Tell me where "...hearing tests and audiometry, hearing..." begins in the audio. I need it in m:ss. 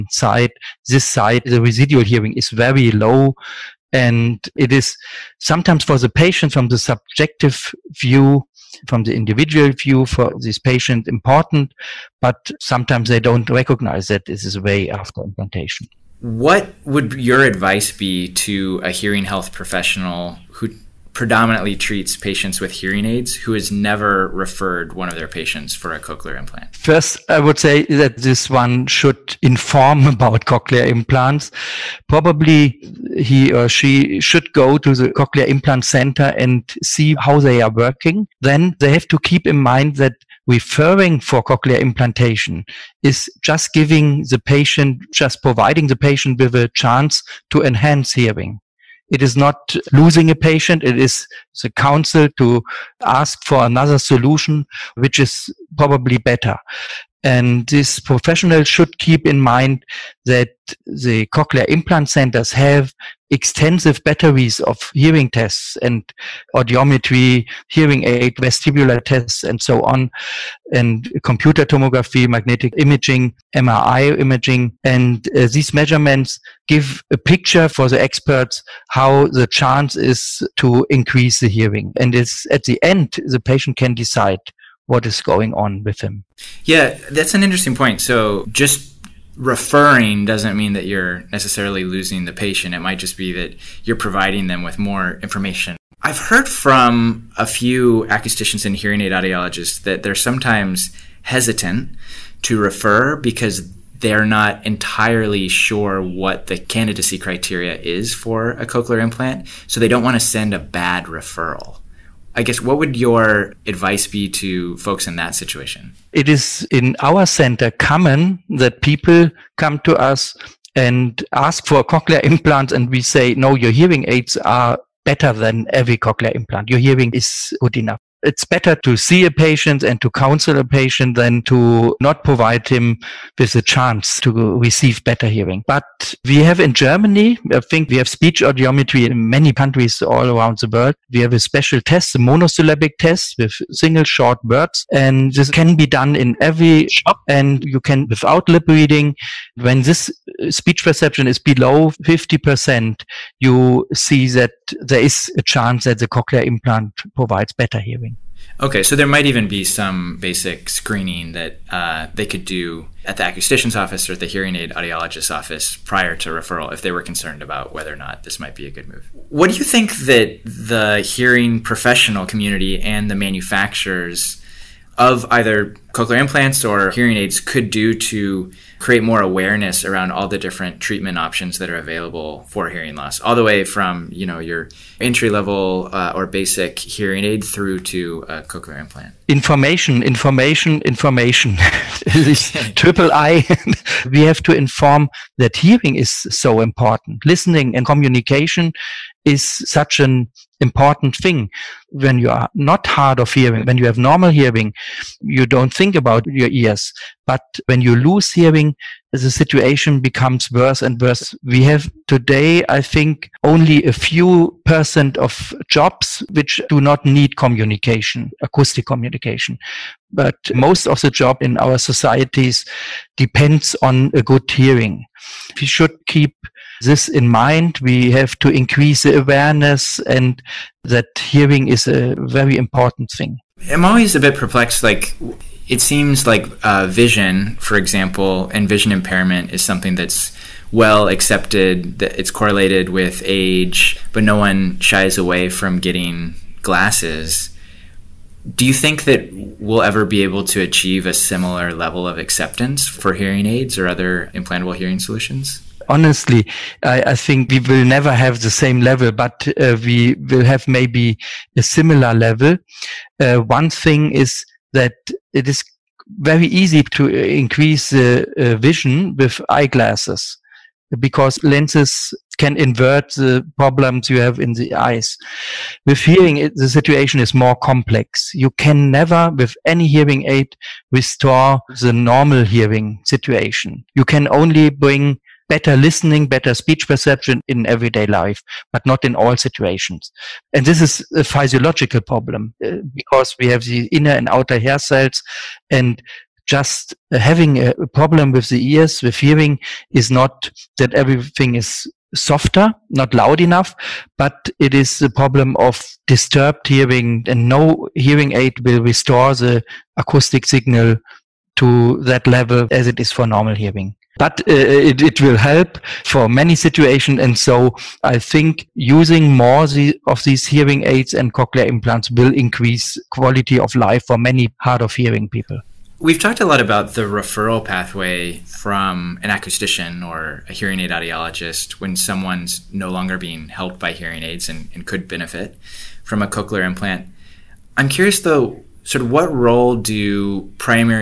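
1:04.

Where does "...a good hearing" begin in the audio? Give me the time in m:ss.
3:44.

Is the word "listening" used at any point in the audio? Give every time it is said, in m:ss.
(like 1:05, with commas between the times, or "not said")
3:17, 4:45.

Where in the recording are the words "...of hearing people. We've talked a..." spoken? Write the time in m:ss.
5:24.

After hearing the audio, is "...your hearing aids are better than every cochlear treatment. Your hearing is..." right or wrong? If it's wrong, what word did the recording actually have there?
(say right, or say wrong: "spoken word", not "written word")
wrong: "implant", not "treatment".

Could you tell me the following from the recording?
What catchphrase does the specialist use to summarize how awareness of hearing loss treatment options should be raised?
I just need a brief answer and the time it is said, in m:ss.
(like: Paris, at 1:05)
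triple I, at 3:12.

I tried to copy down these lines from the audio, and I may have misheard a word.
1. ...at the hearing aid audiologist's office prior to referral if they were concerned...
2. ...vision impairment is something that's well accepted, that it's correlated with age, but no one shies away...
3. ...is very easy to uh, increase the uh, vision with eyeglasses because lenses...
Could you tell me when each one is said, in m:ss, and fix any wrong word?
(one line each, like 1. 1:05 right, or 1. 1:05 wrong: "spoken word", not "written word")
1. 2:44 right
2. 3:58 right
3. 4:25 right.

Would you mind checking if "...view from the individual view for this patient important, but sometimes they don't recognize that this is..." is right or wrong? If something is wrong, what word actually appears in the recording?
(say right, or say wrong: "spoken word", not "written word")
right.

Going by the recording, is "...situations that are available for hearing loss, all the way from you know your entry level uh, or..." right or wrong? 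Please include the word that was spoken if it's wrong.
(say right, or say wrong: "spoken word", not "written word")
wrong: "options", not "situations".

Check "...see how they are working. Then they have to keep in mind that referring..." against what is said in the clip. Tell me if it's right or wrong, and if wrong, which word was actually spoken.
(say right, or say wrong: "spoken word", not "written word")
right.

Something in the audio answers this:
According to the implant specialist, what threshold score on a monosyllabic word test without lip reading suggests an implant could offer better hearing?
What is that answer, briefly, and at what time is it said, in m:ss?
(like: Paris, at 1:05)
below 50%, at 2:31.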